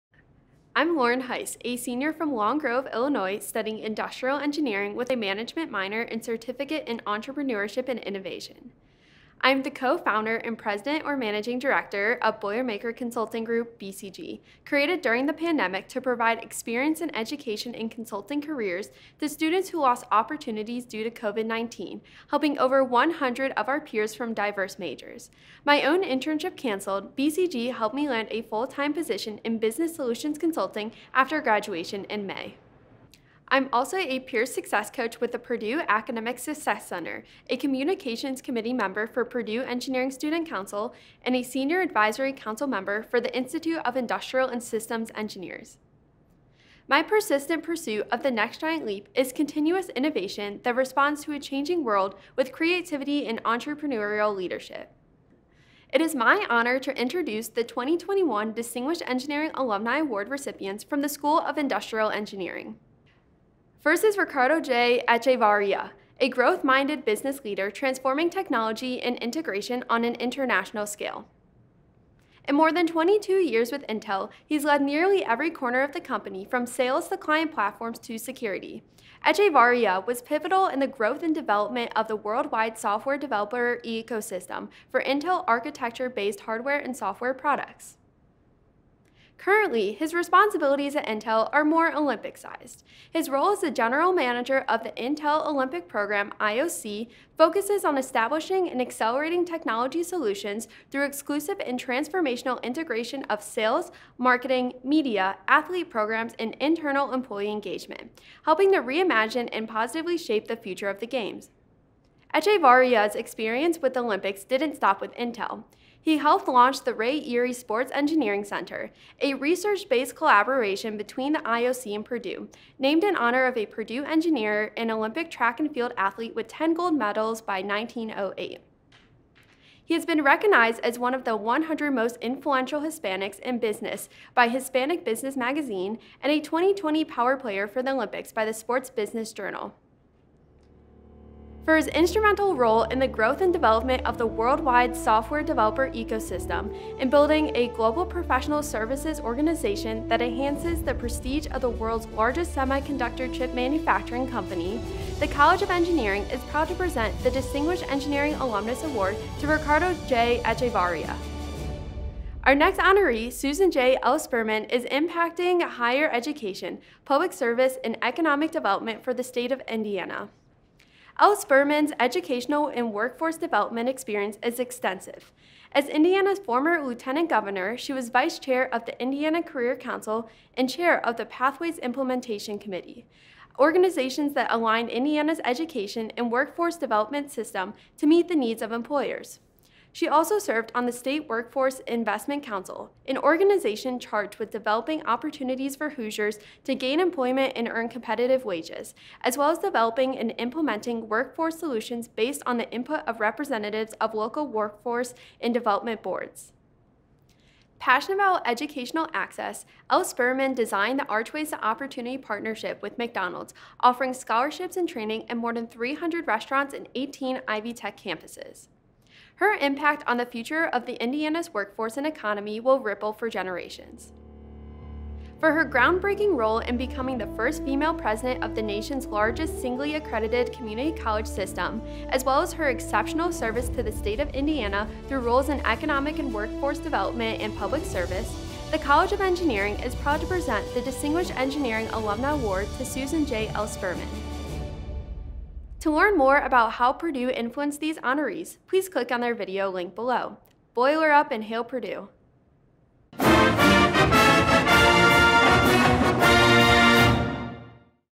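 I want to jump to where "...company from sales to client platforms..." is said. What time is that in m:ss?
1:15.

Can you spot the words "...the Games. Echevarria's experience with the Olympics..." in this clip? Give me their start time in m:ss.
1:50.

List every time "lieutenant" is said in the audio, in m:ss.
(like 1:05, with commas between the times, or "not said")
2:56.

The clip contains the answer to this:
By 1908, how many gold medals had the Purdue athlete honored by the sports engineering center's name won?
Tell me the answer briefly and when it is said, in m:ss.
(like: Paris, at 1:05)
10, at 2:06.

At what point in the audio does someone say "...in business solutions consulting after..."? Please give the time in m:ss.
0:29.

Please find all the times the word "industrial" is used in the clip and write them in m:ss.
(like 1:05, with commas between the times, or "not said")
0:03, 0:43, 1:01.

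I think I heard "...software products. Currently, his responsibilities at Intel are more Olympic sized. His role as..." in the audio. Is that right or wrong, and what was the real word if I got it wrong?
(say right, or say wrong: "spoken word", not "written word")
right.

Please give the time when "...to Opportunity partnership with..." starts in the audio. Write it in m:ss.
3:31.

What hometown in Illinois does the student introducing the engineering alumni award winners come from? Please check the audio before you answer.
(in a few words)
Long Grove.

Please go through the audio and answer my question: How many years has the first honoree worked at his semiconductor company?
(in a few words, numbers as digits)
22.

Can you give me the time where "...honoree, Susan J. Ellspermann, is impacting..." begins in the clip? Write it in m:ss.
2:42.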